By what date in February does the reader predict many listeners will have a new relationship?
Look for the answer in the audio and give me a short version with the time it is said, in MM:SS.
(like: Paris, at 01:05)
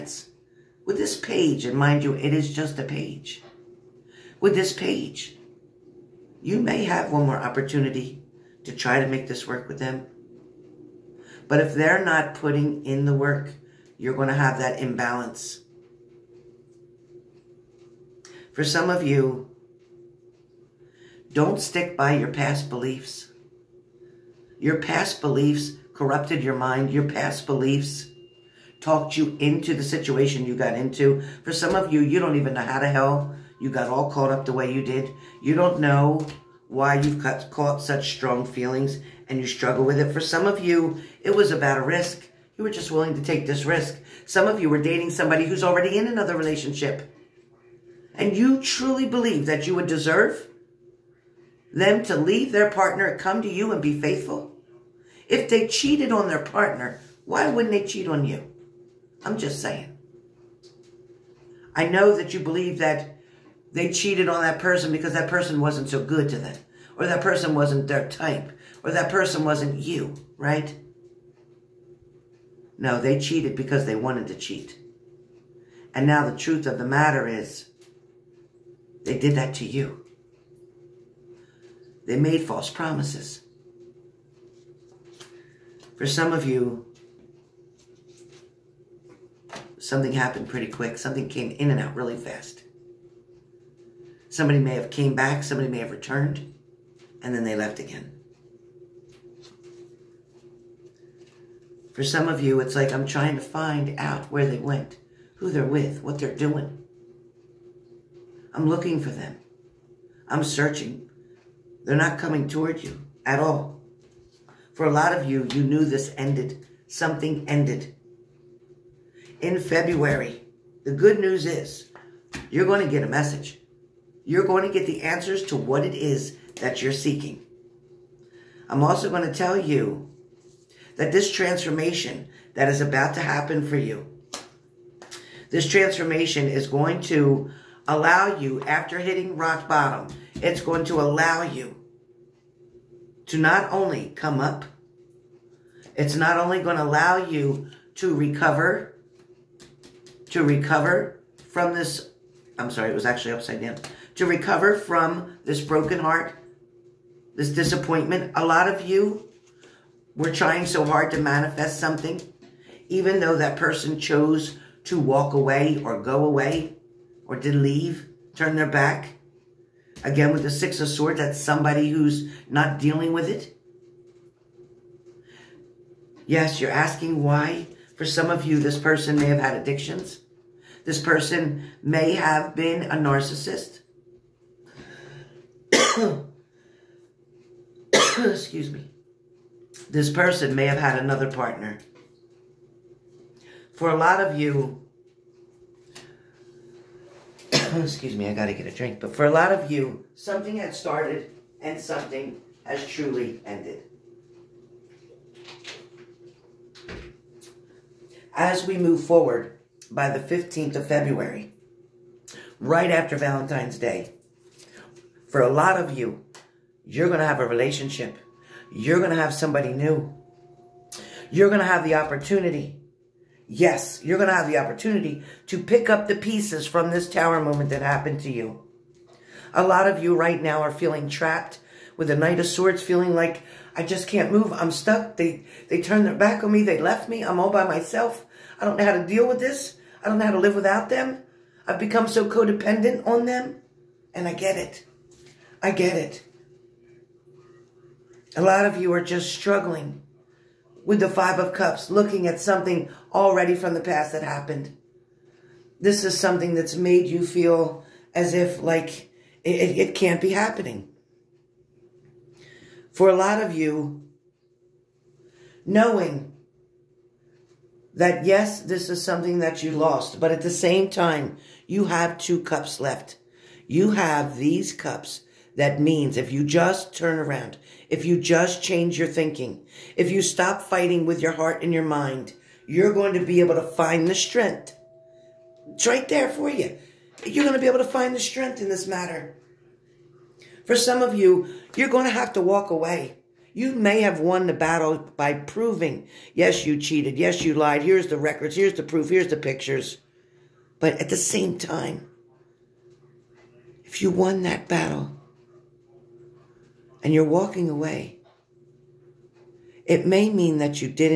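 15th of February, at 03:30.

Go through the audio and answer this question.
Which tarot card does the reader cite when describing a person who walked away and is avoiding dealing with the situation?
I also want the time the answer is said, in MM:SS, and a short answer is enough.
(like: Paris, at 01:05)
Six of Swords, at 02:50.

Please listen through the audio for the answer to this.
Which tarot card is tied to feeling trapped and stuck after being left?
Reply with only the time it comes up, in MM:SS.
03:52.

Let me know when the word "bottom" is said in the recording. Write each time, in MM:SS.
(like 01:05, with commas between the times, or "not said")
02:19.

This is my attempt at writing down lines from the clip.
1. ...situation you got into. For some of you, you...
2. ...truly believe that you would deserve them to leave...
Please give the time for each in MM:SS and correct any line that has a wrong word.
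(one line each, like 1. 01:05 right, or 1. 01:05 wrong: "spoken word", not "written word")
1. 00:29 right
2. 00:48 right.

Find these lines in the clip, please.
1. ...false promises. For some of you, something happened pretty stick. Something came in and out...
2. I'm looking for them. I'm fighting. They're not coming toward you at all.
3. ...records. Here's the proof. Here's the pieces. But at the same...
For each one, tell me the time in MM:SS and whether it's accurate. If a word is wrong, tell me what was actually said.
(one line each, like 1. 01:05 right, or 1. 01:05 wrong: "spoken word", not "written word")
1. 01:22 wrong: "quick", not "stick"
2. 01:48 wrong: "searching", not "fighting"
3. 04:58 wrong: "pictures", not "pieces".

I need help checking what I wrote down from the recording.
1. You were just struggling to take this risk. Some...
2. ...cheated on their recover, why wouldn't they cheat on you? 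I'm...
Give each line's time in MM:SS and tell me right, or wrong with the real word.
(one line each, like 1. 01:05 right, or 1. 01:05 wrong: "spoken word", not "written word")
1. 00:42 wrong: "willing", not "struggling"
2. 00:55 wrong: "partner", not "recover".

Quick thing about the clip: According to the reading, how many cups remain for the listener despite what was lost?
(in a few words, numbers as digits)
2.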